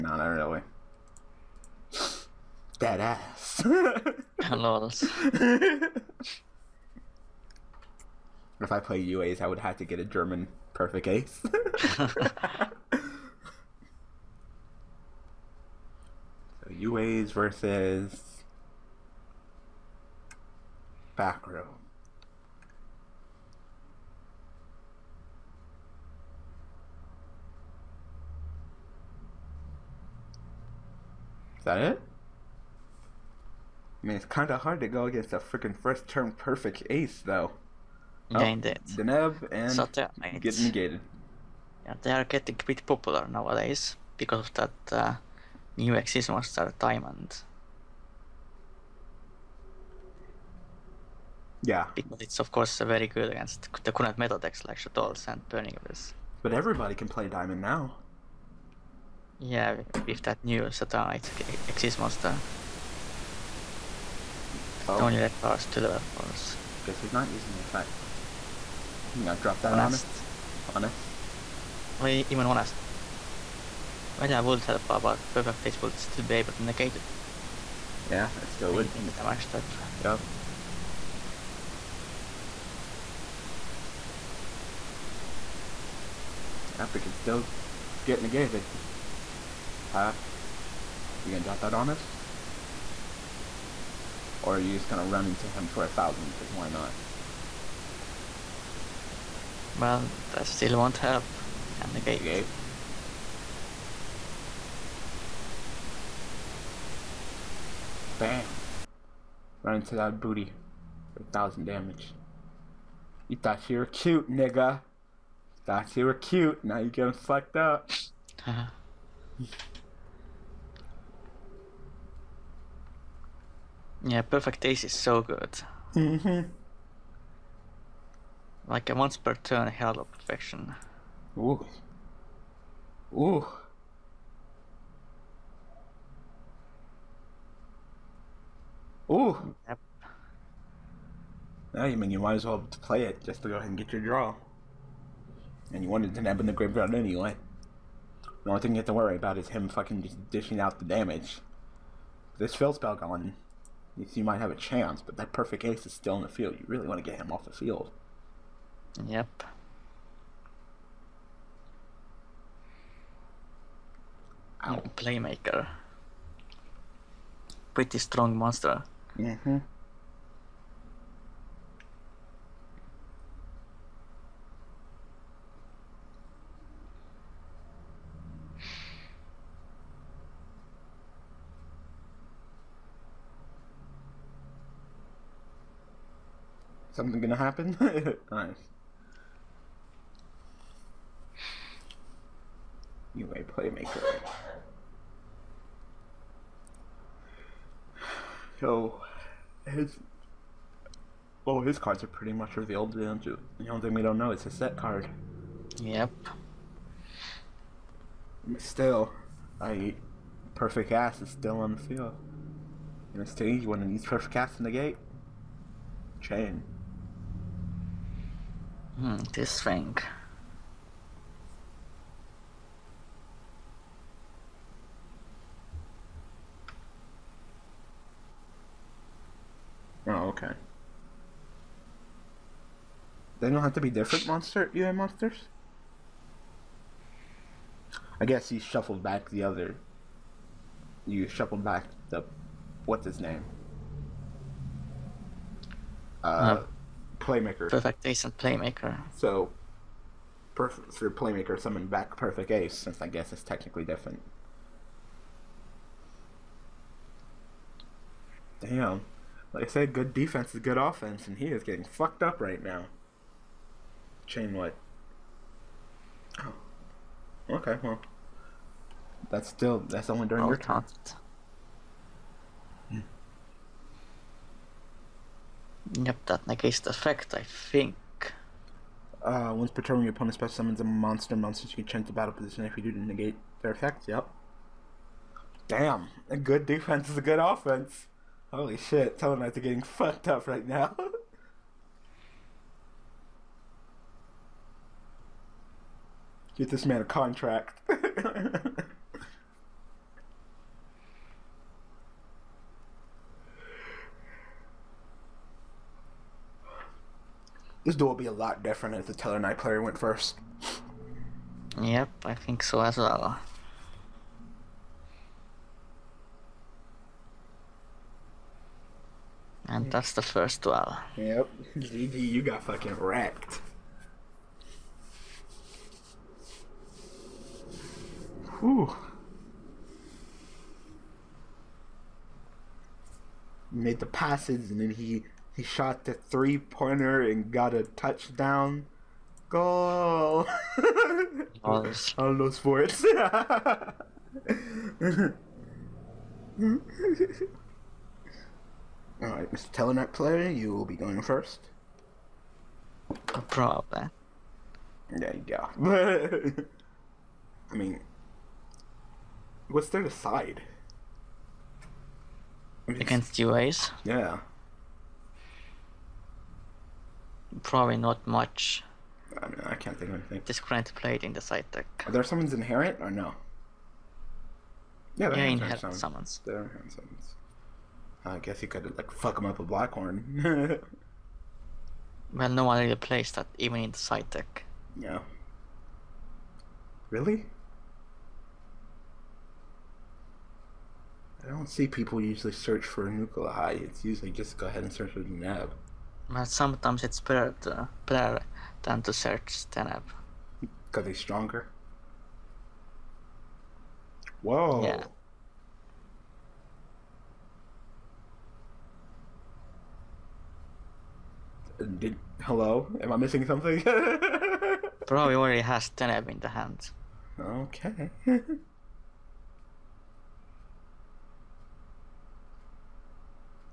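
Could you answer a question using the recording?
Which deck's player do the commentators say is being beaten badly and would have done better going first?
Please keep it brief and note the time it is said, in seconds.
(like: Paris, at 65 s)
Tellarknights, at 289 s.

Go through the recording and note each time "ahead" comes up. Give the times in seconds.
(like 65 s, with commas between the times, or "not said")
143 s, 394 s.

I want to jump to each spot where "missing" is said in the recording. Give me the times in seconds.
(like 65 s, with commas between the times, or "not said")
413 s.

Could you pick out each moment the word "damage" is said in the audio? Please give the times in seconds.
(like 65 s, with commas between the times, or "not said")
79 s, 111 s, 150 s.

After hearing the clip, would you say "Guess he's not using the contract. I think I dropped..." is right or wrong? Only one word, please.
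wrong.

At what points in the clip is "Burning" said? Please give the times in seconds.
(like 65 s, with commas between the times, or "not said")
55 s.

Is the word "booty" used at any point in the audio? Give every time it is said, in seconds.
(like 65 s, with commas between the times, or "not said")
110 s.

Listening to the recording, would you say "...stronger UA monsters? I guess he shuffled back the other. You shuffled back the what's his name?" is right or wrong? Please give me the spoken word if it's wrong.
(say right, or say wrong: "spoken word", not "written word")
wrong: "monster", not "stronger".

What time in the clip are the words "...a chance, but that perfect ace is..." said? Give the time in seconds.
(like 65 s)
154 s.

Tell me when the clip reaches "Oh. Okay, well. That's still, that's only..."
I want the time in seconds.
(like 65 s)
266 s.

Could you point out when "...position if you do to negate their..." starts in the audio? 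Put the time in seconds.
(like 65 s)
282 s.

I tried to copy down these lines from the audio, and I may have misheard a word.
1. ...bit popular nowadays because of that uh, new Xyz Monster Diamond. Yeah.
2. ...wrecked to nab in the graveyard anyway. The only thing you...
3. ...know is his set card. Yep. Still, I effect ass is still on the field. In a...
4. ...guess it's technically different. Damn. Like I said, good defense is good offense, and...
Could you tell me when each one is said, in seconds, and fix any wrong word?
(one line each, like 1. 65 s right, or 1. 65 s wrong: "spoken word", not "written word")
1. 42 s right
2. 145 s wrong: "wanted", not "wrecked"
3. 204 s wrong: "perfect", not "effect"
4. 253 s right.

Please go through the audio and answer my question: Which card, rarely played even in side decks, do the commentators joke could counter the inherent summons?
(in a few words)
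Blackhorn.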